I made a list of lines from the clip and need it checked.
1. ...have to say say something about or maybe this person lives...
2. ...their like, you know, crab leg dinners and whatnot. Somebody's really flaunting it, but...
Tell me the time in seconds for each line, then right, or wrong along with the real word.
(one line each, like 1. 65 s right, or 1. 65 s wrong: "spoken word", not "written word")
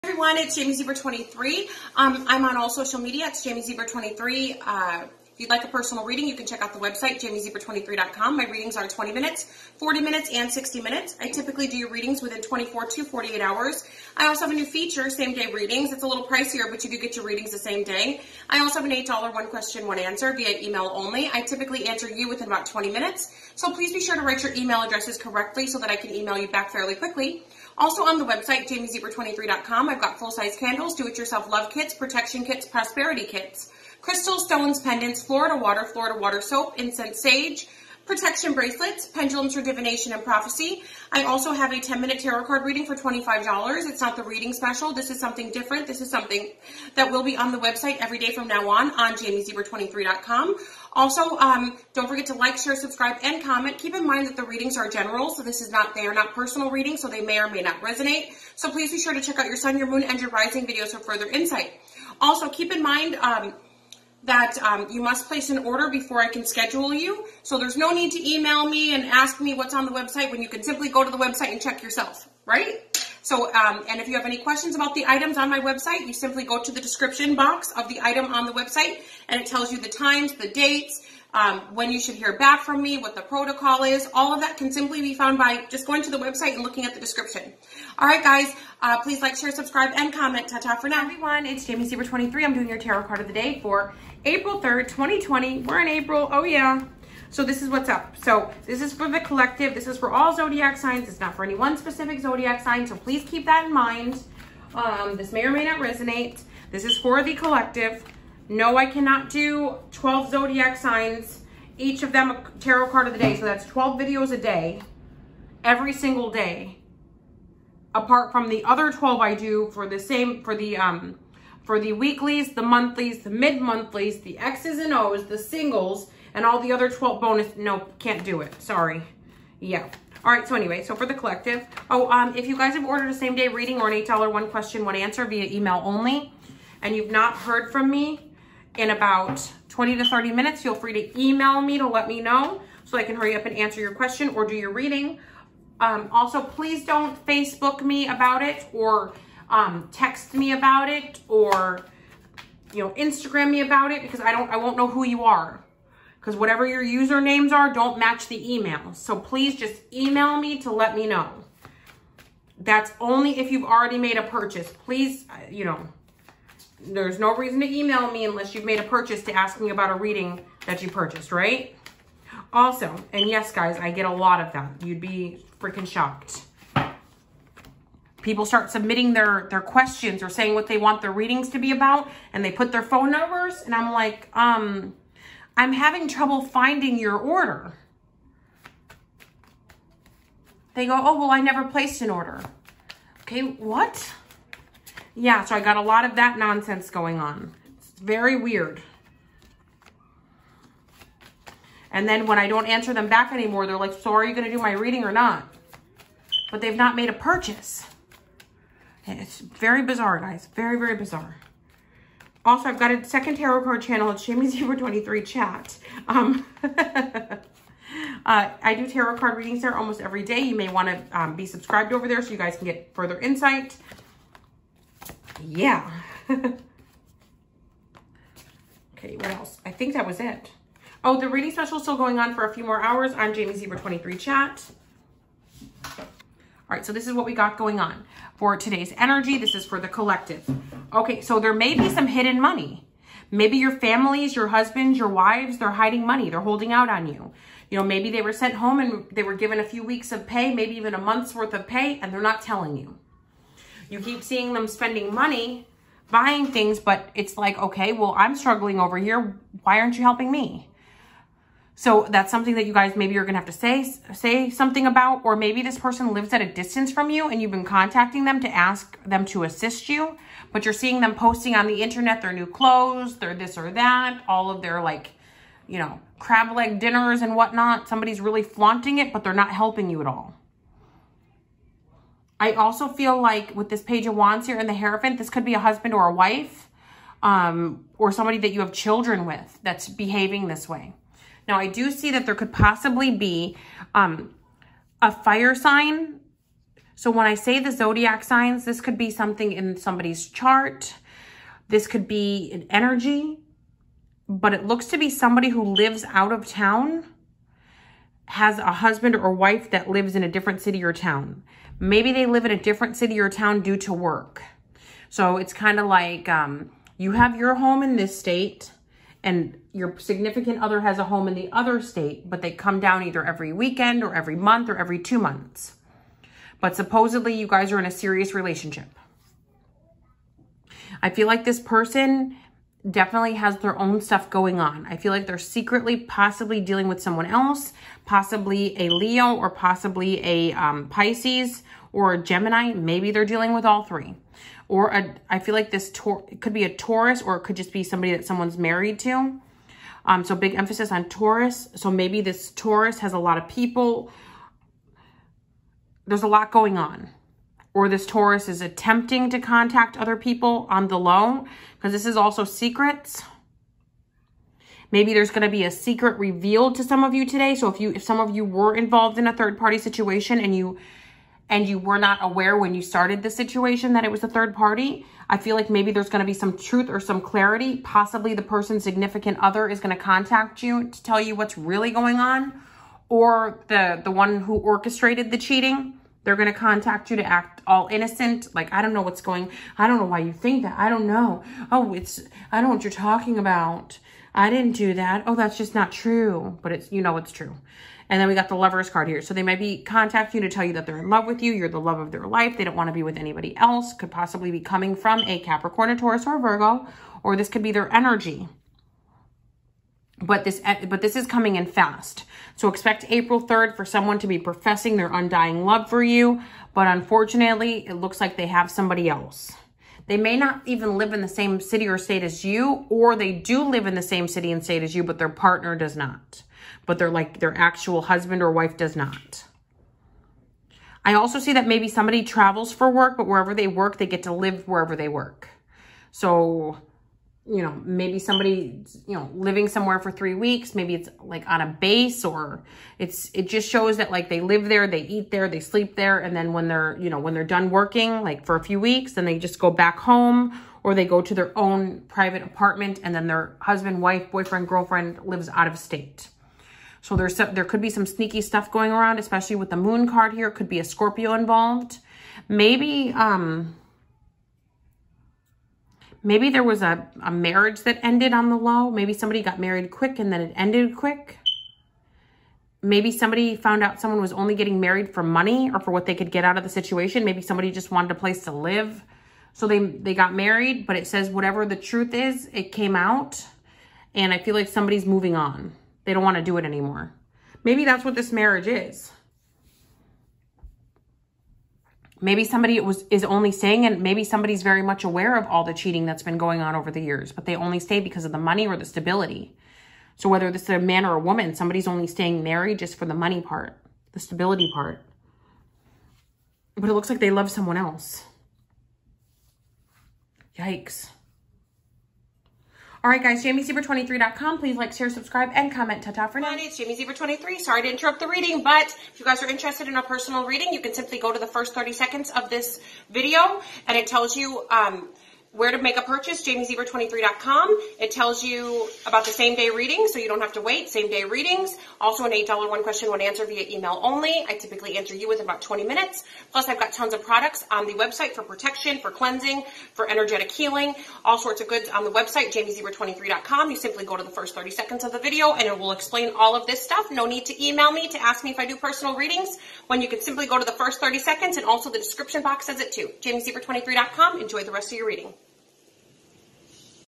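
1. 263 s right
2. 274 s right.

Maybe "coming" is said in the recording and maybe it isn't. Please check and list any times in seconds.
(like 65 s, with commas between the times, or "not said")
404 s, 411 s.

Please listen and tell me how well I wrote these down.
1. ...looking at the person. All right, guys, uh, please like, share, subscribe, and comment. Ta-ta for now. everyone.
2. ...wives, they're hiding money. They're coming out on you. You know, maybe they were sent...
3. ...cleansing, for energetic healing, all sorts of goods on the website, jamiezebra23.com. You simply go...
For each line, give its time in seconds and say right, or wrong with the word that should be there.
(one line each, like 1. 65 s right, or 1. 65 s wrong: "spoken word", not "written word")
1. 86 s wrong: "description", not "person"
2. 245 s wrong: "holding", not "coming"
3. 539 s right.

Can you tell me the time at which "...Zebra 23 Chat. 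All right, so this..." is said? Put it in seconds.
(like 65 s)
233 s.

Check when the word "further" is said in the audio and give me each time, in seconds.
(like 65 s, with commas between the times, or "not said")
60 s, 222 s.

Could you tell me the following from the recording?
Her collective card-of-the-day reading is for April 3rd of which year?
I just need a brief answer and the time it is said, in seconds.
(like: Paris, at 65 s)
2020, at 94 s.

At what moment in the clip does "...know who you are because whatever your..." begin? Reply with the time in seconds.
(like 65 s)
154 s.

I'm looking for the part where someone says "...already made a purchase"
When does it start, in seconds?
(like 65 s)
163 s.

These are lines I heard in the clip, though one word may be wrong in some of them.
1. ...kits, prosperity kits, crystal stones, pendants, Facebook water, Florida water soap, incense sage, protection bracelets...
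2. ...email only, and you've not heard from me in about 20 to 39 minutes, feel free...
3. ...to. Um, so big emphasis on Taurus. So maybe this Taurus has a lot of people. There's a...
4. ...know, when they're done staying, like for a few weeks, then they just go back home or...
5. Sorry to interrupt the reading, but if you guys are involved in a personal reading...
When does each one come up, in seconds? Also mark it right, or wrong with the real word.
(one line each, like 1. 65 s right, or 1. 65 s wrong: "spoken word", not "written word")
1. 32 s wrong: "Florida", not "Facebook"
2. 135 s wrong: "30", not "39"
3. 348 s right
4. 447 s wrong: "working", not "staying"
5. 517 s wrong: "interested", not "involved".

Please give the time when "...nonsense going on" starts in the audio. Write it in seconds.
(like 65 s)
196 s.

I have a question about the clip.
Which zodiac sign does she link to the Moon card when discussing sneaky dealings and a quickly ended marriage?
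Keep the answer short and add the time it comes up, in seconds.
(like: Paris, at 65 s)
Scorpio, at 460 s.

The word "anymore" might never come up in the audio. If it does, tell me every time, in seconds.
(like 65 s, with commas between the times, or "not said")
203 s, 486 s.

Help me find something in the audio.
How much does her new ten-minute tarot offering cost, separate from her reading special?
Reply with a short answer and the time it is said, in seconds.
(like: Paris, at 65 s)
$25, at 42 s.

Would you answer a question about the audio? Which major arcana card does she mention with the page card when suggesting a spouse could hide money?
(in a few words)
The Hierophant.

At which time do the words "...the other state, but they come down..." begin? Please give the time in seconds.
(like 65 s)
321 s.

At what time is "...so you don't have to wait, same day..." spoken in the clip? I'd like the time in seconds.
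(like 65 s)
530 s.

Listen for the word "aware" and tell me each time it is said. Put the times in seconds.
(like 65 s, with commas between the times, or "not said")
372 s, 495 s.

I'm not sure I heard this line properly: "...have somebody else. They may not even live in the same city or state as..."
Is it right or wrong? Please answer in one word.
right.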